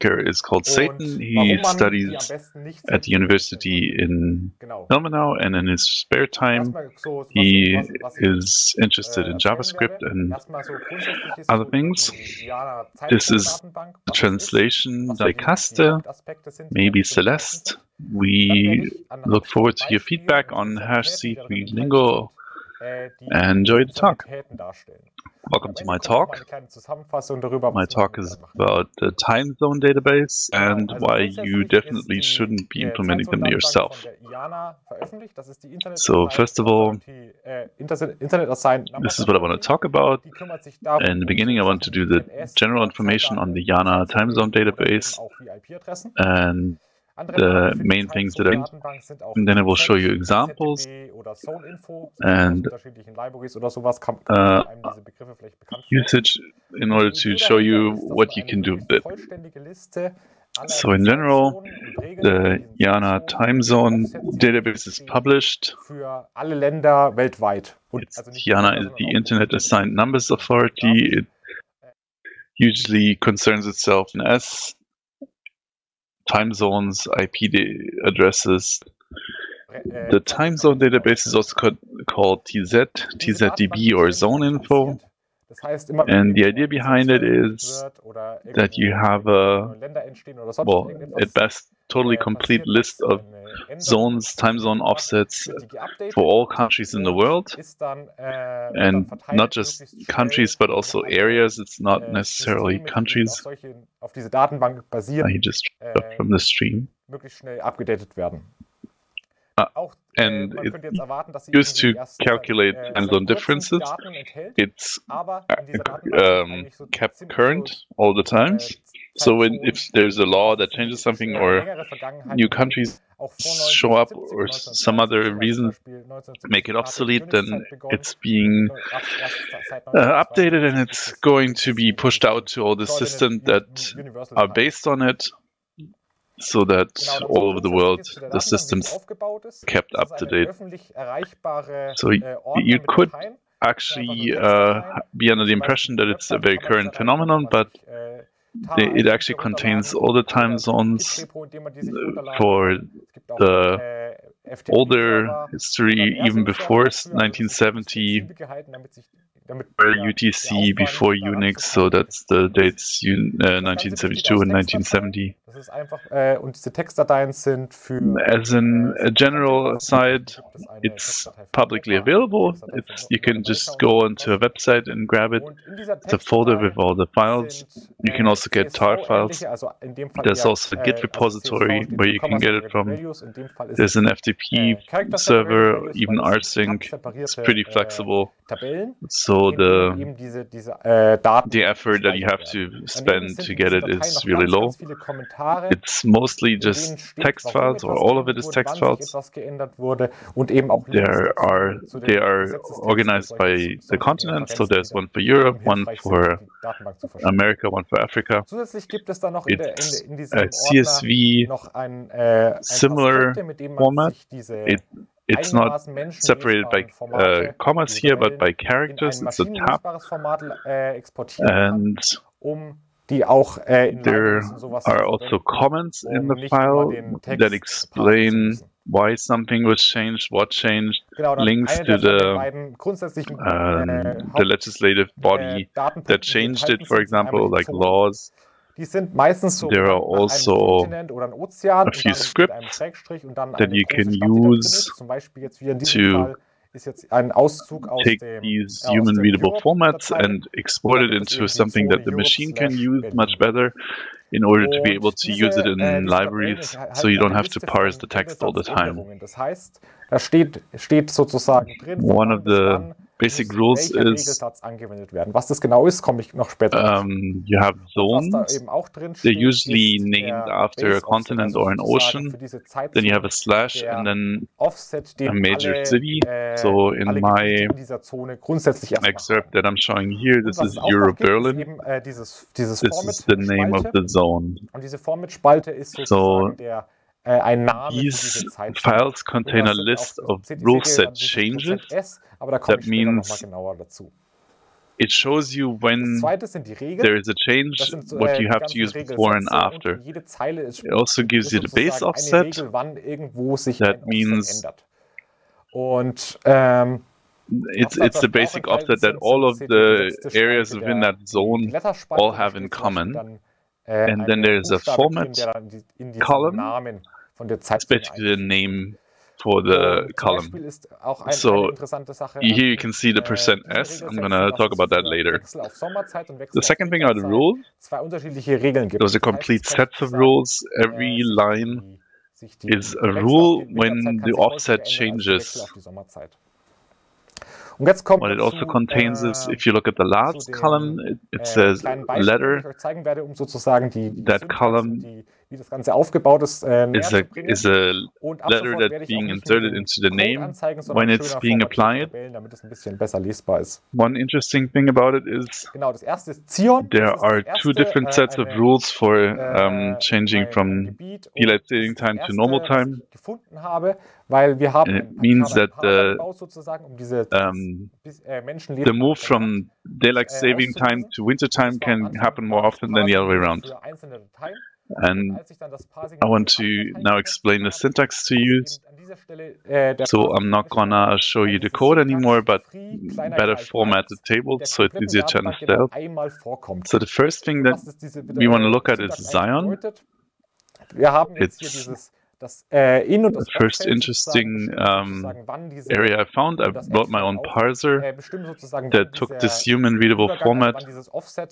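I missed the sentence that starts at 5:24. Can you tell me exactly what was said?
am going to talk about that later.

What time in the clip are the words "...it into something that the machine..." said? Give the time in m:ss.
4:11.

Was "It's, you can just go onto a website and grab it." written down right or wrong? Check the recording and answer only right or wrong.
right.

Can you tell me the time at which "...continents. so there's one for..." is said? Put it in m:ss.
3:24.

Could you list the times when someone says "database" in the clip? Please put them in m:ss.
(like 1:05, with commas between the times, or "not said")
0:29, 0:44, 1:04, 1:20.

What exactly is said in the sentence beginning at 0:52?
And uh, usage in order to show you what you can do with it.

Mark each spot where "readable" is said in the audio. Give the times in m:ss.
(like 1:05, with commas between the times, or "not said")
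4:09, 6:39.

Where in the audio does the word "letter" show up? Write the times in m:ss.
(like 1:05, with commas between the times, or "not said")
5:41, 5:48.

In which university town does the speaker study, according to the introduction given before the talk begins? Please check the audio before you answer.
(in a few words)
Ilmenau.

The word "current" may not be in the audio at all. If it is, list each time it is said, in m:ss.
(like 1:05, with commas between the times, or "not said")
1:57, 2:26.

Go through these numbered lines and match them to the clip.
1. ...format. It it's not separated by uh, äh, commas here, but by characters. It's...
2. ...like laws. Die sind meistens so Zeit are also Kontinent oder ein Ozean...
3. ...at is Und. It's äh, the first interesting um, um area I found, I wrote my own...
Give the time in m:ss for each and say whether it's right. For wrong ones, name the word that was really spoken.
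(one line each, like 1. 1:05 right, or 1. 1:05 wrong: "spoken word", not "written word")
1. 3:33 right
2. 3:57 wrong: "There", not "Zeit"
3. 6:28 wrong: "Zion", not "Und".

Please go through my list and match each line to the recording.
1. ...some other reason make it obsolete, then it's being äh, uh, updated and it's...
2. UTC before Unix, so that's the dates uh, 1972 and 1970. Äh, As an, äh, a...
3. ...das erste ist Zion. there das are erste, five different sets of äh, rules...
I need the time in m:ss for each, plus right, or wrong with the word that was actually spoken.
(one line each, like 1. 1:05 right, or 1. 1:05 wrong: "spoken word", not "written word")
1. 2:04 right
2. 2:39 right
3. 5:55 wrong: "two", not "five".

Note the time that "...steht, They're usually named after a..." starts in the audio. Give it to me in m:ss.
4:29.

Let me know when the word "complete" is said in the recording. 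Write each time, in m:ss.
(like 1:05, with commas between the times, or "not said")
1:32, 5:29.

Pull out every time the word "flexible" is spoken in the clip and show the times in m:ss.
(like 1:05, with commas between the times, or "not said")
3:07.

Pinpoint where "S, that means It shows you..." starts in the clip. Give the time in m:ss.
4:51.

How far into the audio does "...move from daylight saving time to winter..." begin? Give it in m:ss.
6:08.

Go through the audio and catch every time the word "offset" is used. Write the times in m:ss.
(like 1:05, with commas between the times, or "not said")
1:34, 4:34, 5:02, 5:08, 5:34.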